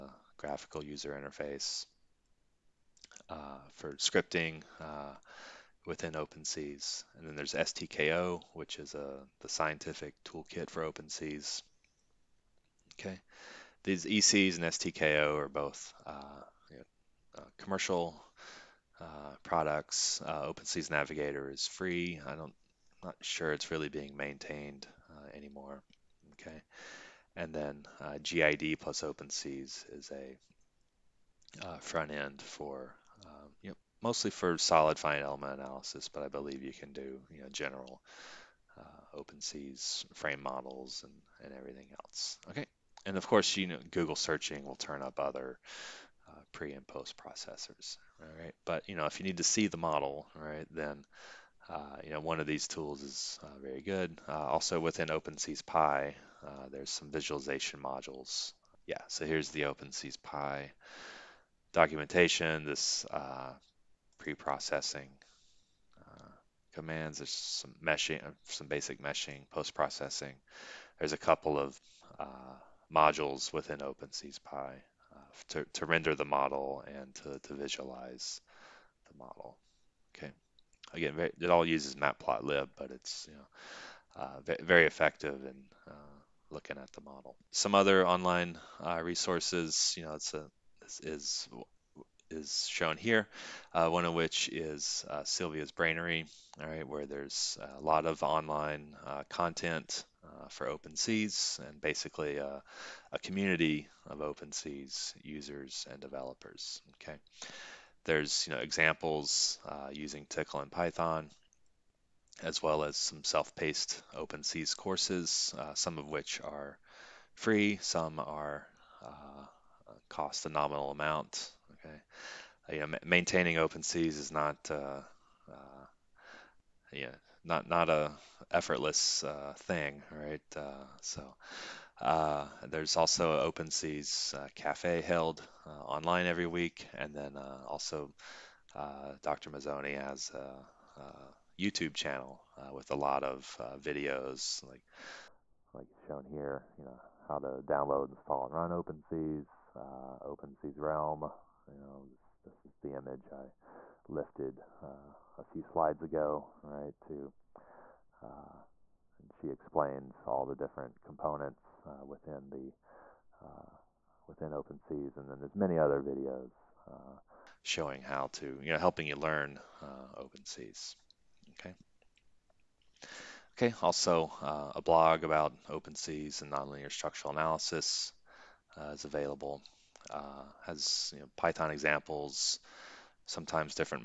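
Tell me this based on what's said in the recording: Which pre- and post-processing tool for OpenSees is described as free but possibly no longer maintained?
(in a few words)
OpenSees Navigator.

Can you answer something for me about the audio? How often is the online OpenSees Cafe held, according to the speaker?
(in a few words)
Every week.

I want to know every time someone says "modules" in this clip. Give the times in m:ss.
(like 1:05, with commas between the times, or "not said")
0:57, 1:12.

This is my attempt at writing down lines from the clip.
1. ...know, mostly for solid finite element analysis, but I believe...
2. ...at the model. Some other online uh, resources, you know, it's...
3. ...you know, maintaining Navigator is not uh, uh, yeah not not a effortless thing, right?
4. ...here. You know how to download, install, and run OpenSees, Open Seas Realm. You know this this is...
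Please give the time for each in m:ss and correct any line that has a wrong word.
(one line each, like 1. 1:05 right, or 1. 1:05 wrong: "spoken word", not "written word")
1. 0:33 right
2. 1:26 right
3. 2:02 wrong: "OpenSees", not "Navigator"
4. 2:26 right.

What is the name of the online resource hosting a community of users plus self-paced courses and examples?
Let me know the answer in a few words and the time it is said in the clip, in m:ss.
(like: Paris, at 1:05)
Silvia's Brainery, at 1:35.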